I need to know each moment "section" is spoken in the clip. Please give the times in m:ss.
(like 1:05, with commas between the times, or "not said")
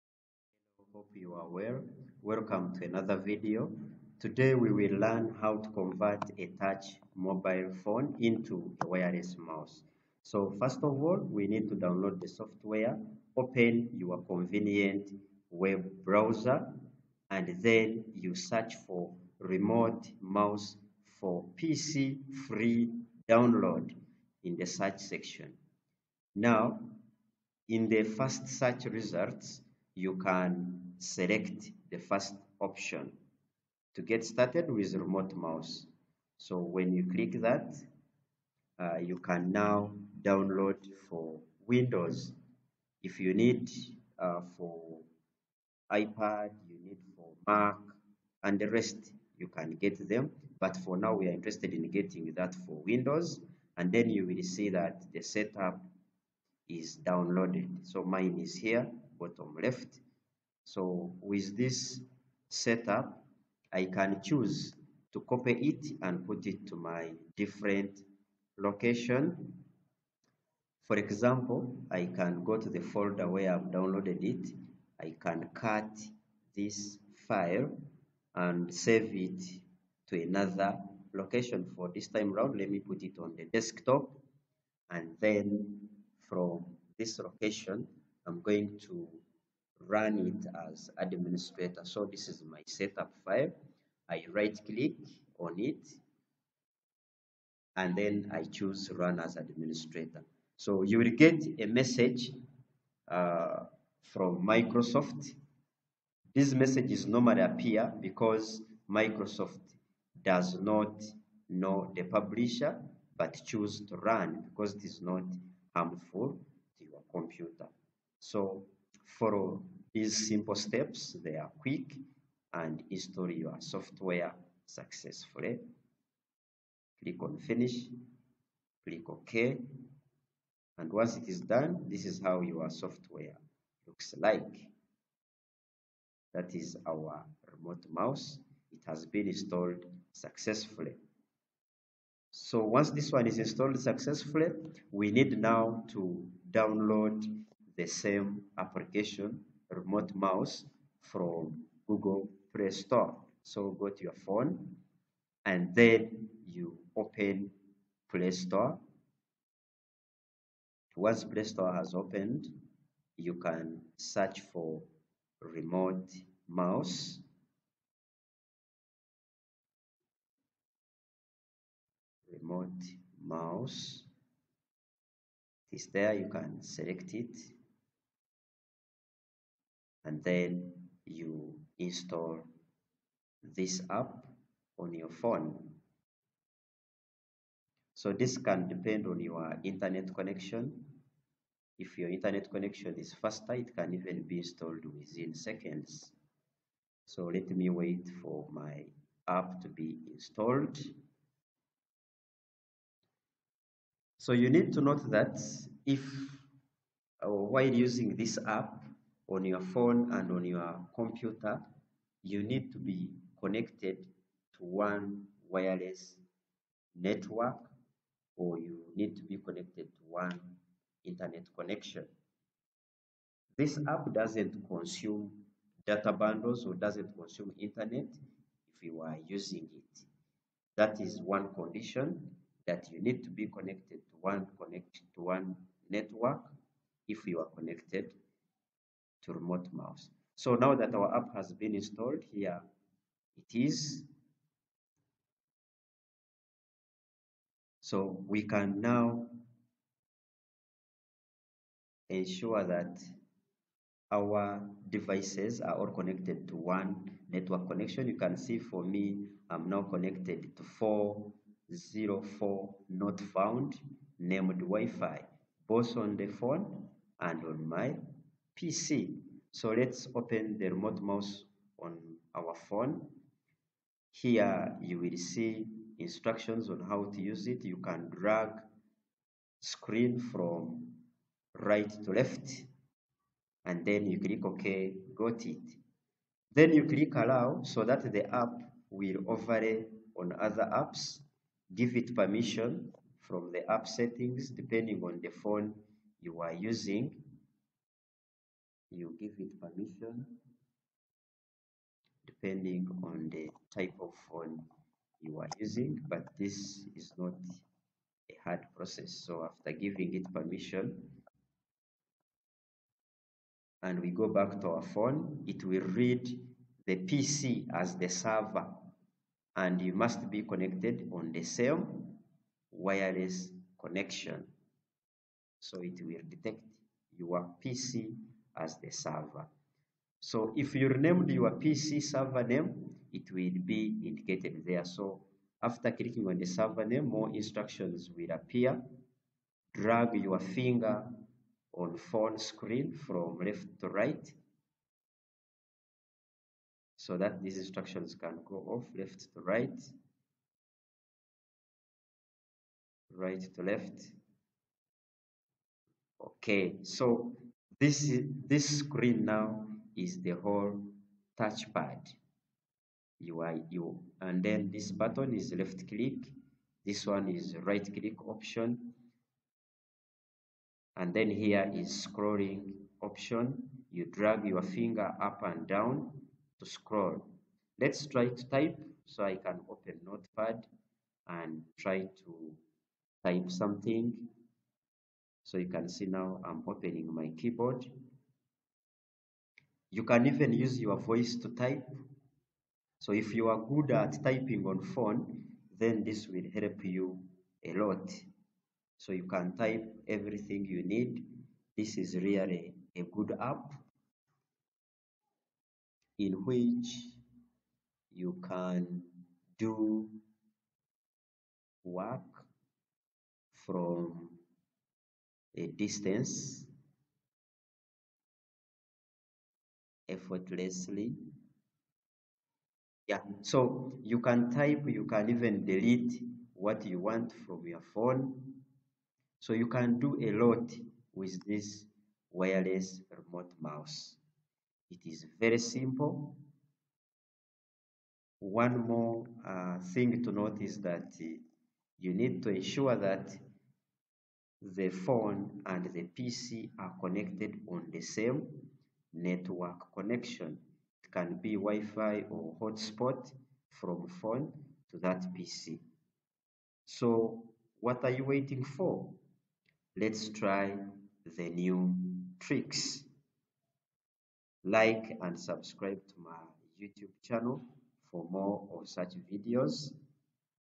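0:24.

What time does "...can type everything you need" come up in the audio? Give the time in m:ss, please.
6:39.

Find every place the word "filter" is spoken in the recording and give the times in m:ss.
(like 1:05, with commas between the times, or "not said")
not said.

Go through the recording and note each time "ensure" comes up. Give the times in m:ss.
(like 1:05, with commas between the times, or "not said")
4:12, 7:22.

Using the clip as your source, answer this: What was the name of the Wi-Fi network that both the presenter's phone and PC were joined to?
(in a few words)
404 not found.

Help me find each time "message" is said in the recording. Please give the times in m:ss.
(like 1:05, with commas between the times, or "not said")
1:41, 1:46.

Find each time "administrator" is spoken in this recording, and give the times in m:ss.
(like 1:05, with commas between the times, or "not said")
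1:30, 1:39.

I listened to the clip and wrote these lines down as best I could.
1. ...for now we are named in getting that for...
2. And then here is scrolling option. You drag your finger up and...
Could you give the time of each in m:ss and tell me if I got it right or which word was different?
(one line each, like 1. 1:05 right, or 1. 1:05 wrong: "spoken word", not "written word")
1. 0:50 wrong: "interested", not "named"
2. 6:10 right.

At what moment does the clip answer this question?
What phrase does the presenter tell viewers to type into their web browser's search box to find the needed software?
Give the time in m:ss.
0:19.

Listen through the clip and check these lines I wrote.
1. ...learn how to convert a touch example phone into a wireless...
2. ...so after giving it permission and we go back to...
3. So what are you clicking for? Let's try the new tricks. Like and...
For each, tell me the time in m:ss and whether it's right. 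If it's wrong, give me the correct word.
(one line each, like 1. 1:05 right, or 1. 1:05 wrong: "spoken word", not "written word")
1. 0:04 wrong: "mobile", not "example"
2. 5:09 right
3. 7:36 wrong: "waiting", not "clicking".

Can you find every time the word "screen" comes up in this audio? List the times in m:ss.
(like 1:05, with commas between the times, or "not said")
4:39, 5:42, 5:58.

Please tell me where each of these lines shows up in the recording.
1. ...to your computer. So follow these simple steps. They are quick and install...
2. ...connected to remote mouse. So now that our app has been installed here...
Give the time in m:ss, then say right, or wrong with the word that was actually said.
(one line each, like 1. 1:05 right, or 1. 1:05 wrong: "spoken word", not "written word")
1. 1:56 right
2. 3:57 right.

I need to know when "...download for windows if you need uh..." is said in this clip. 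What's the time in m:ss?
0:40.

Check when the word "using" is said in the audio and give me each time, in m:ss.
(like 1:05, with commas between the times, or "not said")
3:27, 3:49, 4:56, 5:05.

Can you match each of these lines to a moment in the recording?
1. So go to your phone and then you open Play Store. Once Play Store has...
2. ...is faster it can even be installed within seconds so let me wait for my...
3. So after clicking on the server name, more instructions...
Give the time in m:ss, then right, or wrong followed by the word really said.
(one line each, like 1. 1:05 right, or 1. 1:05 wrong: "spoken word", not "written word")
1. 2:33 right
2. 3:12 right
3. 5:34 right.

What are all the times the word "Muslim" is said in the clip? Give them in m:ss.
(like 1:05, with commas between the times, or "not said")
not said.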